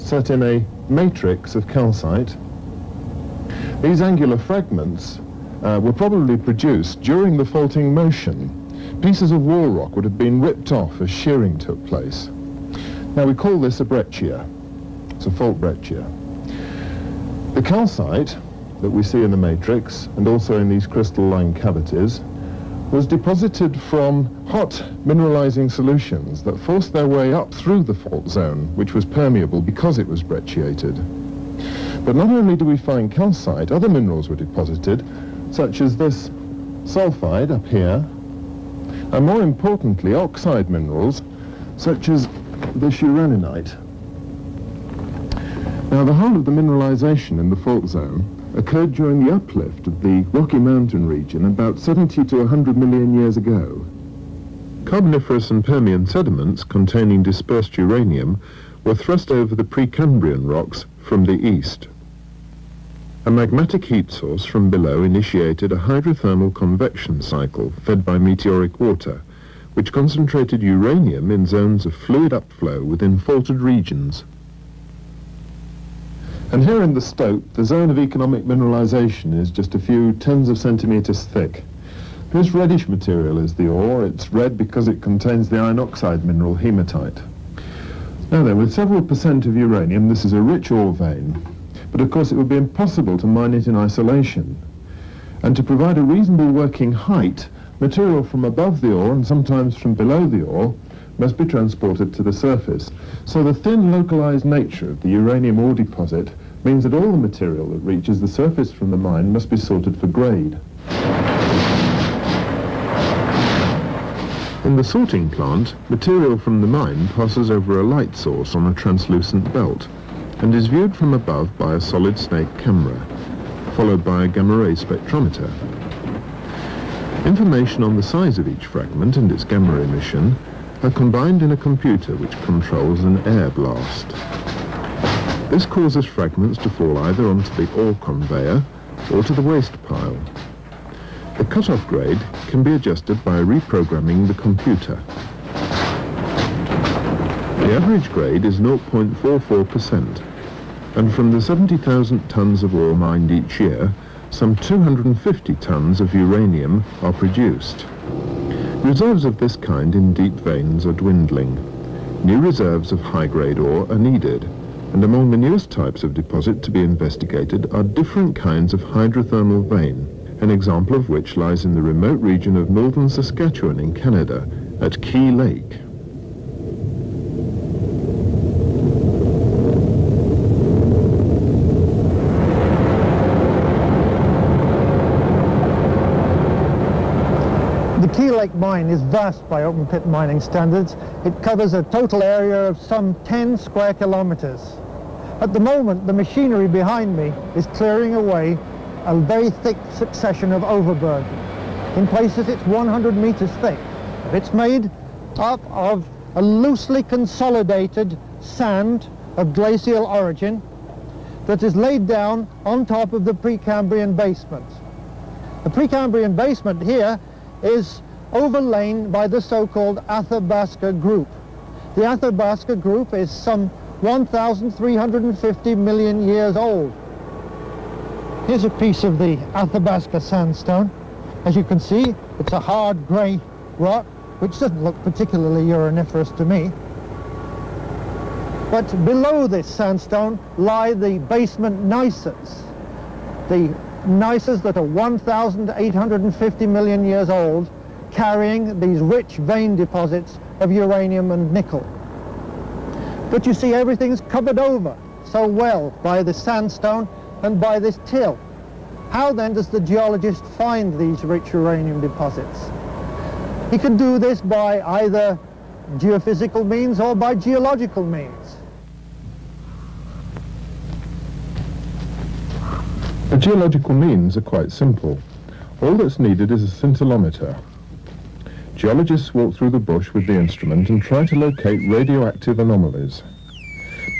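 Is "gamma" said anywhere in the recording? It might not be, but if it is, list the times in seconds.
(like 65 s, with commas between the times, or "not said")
124 s, 129 s.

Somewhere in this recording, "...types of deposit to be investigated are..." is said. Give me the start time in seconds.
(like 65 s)
165 s.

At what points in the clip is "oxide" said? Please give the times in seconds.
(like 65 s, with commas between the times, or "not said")
40 s, 85 s.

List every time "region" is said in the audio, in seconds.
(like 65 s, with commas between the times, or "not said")
51 s, 73 s, 172 s.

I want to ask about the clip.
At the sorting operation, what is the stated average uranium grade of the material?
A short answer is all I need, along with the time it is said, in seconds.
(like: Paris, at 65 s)
0.44%, at 148 s.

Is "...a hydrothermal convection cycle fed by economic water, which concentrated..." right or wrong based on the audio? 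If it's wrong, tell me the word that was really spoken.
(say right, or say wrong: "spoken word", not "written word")
wrong: "meteoric", not "economic".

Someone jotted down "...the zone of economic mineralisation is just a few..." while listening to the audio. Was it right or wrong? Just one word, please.
right.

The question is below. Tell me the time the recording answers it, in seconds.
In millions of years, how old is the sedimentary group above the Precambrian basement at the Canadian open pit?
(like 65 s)
224 s.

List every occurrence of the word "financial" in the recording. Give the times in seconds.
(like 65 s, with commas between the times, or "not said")
not said.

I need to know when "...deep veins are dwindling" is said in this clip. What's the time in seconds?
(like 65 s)
160 s.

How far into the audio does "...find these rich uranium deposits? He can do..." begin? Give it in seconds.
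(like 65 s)
260 s.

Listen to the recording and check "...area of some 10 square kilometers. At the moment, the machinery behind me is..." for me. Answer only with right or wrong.
right.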